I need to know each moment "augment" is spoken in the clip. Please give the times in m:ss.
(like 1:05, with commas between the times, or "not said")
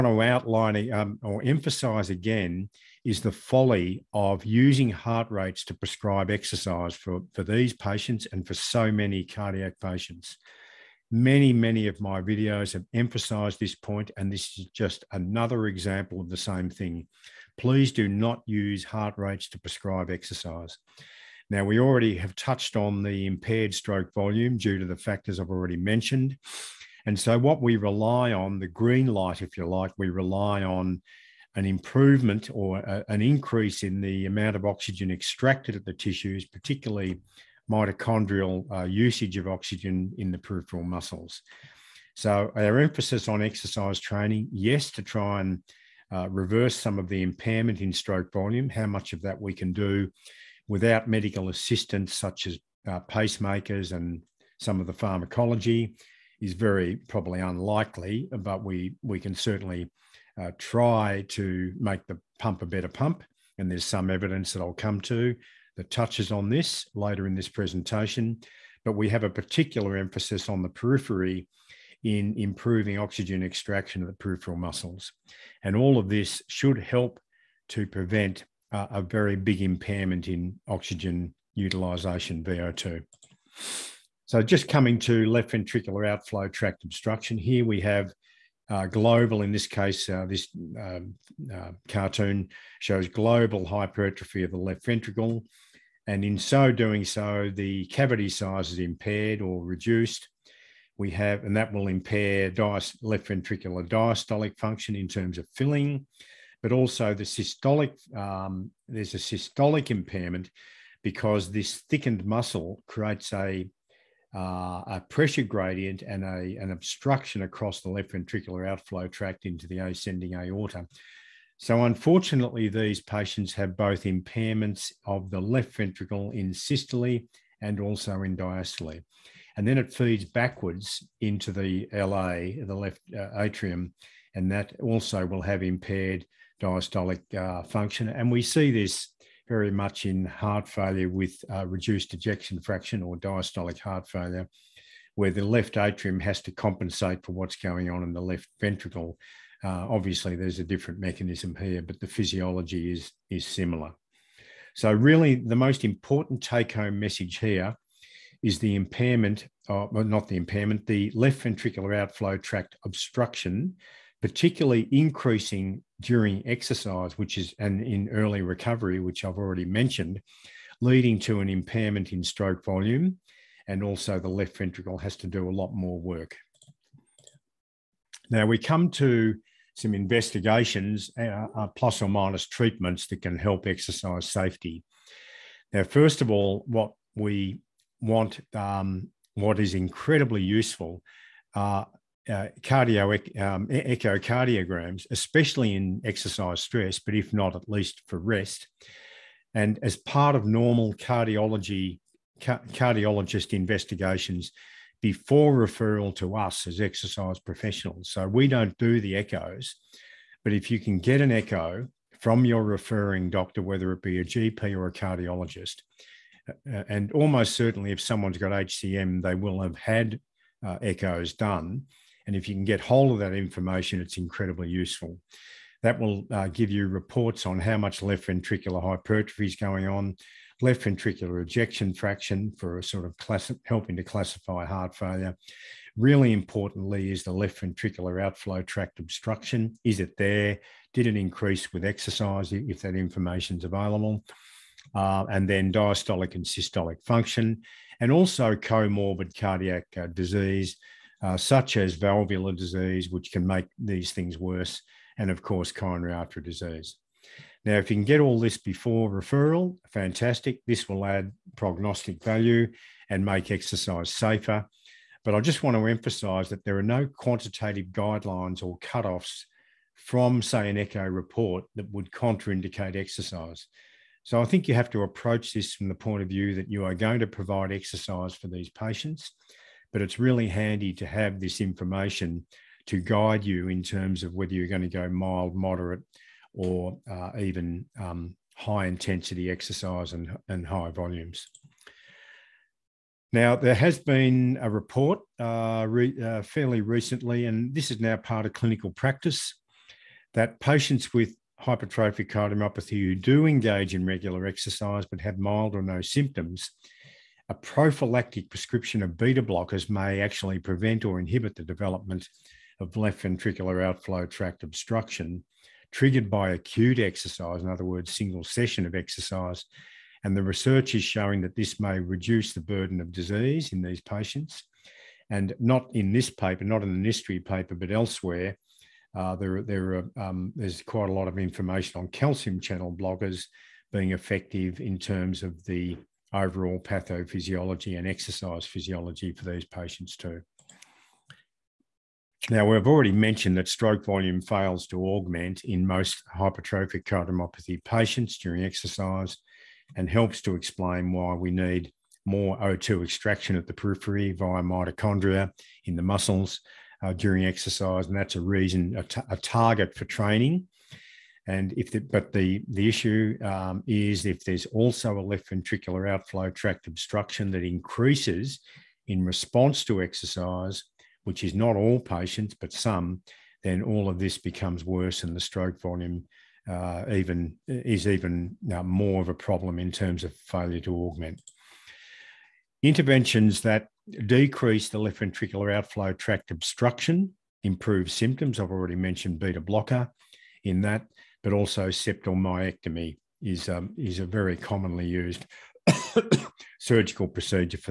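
5:45, 6:20.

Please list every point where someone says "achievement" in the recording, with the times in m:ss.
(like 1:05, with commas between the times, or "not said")
not said.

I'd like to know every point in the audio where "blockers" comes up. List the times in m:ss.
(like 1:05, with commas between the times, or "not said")
5:09, 5:32, 6:29.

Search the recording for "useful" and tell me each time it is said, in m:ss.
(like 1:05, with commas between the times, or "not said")
3:10, 3:44.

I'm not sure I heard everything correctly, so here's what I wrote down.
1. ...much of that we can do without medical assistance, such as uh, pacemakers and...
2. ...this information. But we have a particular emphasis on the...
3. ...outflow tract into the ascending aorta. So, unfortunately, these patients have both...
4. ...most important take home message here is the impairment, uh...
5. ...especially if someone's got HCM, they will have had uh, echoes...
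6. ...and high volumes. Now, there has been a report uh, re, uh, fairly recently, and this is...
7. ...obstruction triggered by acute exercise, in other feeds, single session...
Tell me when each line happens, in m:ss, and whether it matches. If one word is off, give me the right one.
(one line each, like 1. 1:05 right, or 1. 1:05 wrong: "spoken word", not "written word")
1. 0:48 right
2. 1:07 wrong: "presentation", not "information"
3. 1:58 right
4. 2:35 right
5. 3:37 wrong: "certainly", not "especially"
6. 4:50 right
7. 5:14 wrong: "words", not "feeds".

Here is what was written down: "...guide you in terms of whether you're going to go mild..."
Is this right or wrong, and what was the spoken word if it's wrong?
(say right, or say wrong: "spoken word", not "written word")
right.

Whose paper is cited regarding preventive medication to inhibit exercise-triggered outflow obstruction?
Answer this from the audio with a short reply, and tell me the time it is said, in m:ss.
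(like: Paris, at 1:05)
Nistri, at 5:27.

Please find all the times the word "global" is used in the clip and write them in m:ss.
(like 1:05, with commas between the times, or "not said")
1:28, 1:33.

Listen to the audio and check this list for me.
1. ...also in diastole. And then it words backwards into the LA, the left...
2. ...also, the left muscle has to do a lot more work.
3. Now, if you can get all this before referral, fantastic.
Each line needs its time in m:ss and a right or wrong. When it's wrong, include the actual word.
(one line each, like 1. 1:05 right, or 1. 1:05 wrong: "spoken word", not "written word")
1. 2:07 wrong: "feeds", not "words"
2. 2:53 wrong: "ventricle", not "muscle"
3. 4:17 right.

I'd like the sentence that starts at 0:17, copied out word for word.
Please do not use heart rates to prescribe exercise.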